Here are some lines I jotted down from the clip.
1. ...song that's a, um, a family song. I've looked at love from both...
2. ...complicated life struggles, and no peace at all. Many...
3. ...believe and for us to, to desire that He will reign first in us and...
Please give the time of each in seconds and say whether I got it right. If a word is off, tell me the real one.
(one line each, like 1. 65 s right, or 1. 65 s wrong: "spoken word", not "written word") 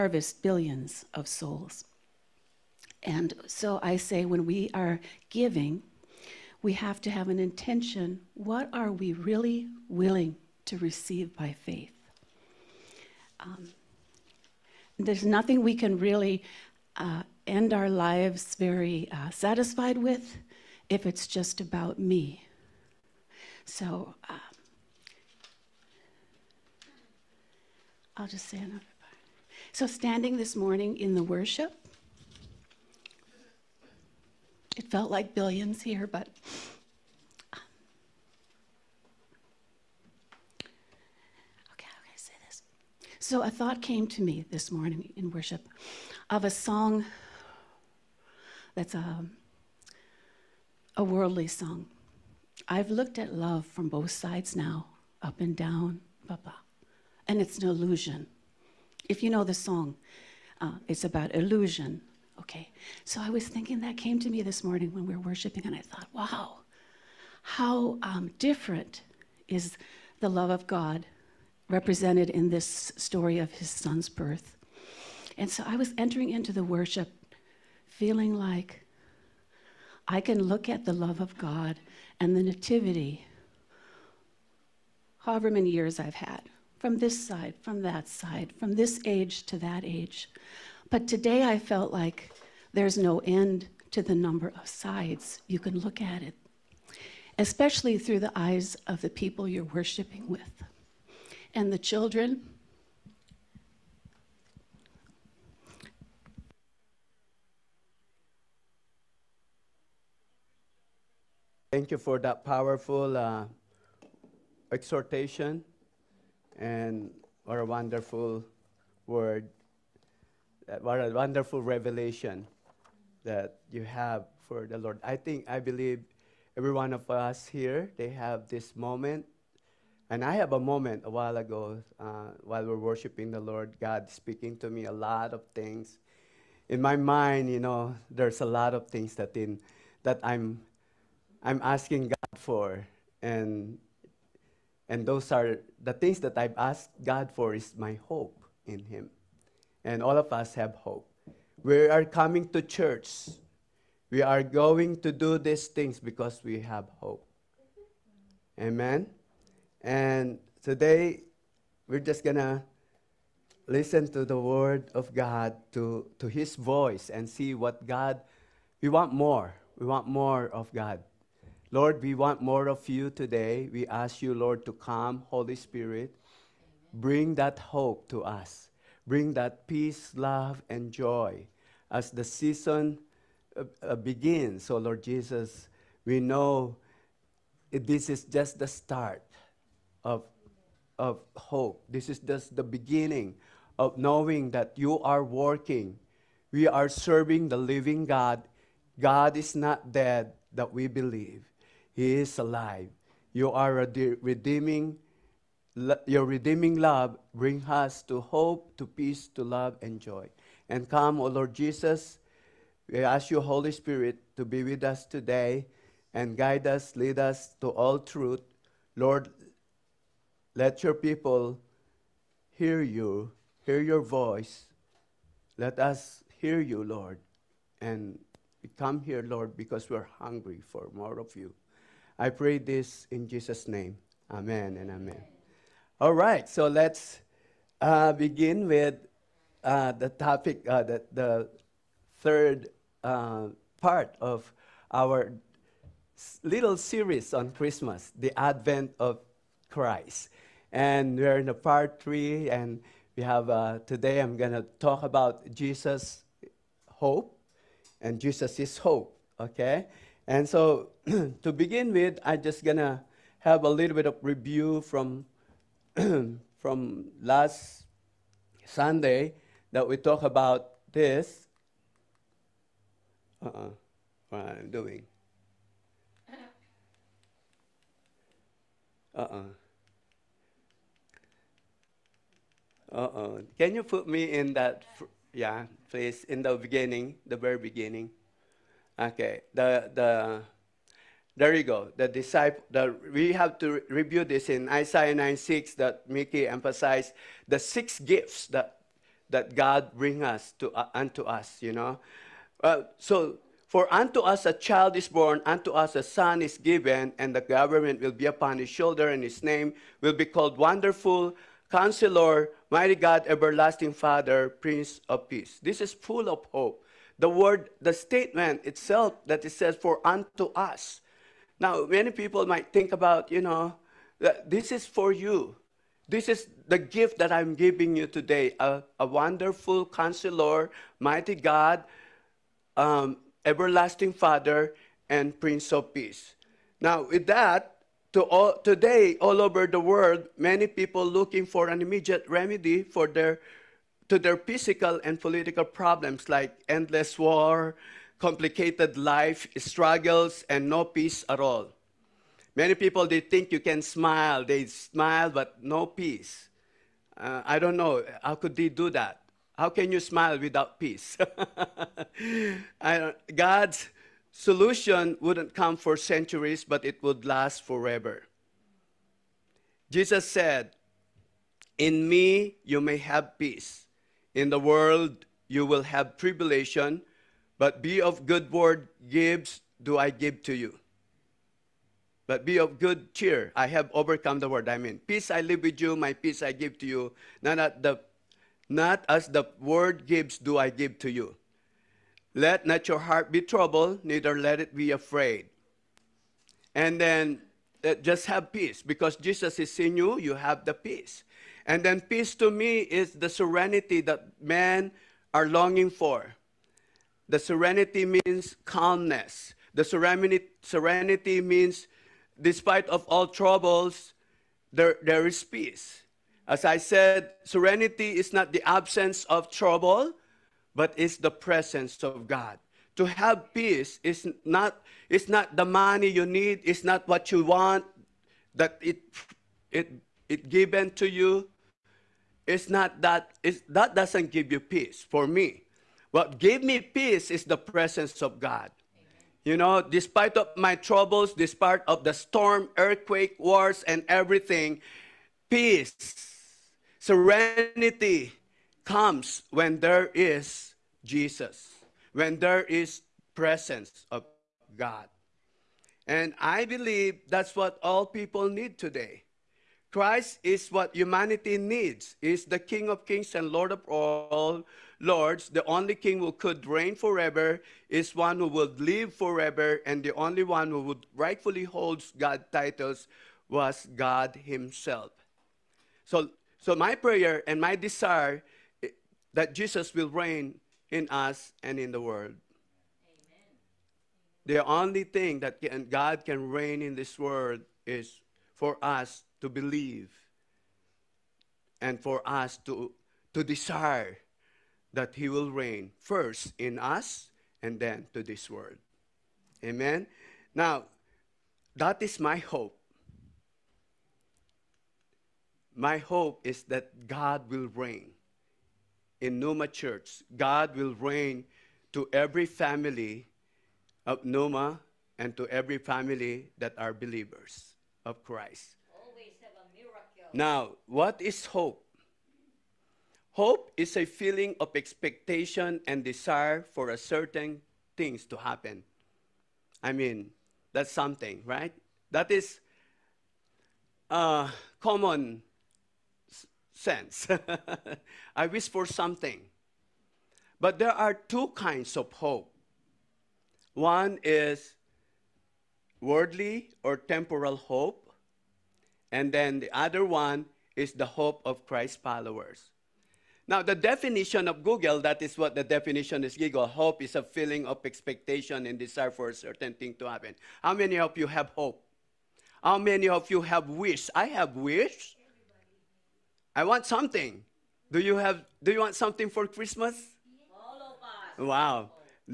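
1. 46 s wrong: "worldly", not "family"
2. 348 s right
3. 489 s right.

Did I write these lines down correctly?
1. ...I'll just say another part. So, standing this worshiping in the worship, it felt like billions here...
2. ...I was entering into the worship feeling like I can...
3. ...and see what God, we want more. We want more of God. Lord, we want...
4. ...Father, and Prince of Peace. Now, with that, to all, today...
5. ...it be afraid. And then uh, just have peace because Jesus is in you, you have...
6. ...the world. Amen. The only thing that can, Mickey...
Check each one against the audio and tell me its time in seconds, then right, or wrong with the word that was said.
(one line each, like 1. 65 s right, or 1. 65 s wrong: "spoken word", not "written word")
1. 28 s wrong: "morning", not "worshiping"
2. 75 s right
3. 167 s right
4. 334 s right
5. 394 s right
6. 481 s wrong: "God", not "Mickey".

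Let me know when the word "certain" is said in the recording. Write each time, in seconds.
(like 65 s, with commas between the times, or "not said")
526 s, 559 s.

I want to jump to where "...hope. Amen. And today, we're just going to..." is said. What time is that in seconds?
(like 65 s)
157 s.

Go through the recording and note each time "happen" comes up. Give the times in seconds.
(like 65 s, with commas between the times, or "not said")
528 s, 560 s.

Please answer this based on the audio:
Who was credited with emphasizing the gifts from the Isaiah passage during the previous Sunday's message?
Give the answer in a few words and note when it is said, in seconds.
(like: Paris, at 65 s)
Mickey, at 296 s.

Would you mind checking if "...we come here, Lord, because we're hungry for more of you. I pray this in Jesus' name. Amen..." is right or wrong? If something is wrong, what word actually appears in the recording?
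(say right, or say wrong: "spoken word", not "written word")
right.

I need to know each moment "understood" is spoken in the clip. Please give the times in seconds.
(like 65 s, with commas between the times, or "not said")
not said.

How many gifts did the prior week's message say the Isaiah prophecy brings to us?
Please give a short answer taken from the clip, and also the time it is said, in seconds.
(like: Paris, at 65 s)
6, at 297 s.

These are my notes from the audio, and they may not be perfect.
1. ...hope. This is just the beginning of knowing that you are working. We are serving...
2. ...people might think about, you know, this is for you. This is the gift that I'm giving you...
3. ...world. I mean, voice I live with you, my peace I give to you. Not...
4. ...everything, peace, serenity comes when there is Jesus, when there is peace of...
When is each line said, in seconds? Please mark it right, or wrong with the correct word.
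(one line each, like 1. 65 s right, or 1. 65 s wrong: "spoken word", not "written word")
1. 191 s right
2. 322 s right
3. 384 s wrong: "peace", not "voice"
4. 444 s wrong: "presence", not "peace".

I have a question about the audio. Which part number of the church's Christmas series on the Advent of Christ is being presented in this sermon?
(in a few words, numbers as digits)
3.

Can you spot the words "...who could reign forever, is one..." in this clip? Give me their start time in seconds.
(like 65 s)
466 s.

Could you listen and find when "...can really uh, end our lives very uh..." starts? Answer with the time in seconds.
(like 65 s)
15 s.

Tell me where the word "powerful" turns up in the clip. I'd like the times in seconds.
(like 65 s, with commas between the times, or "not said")
112 s.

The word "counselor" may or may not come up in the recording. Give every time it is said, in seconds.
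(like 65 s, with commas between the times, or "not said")
311 s, 329 s.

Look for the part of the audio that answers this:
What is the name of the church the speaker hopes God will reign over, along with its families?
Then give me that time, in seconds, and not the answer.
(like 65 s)
509 s.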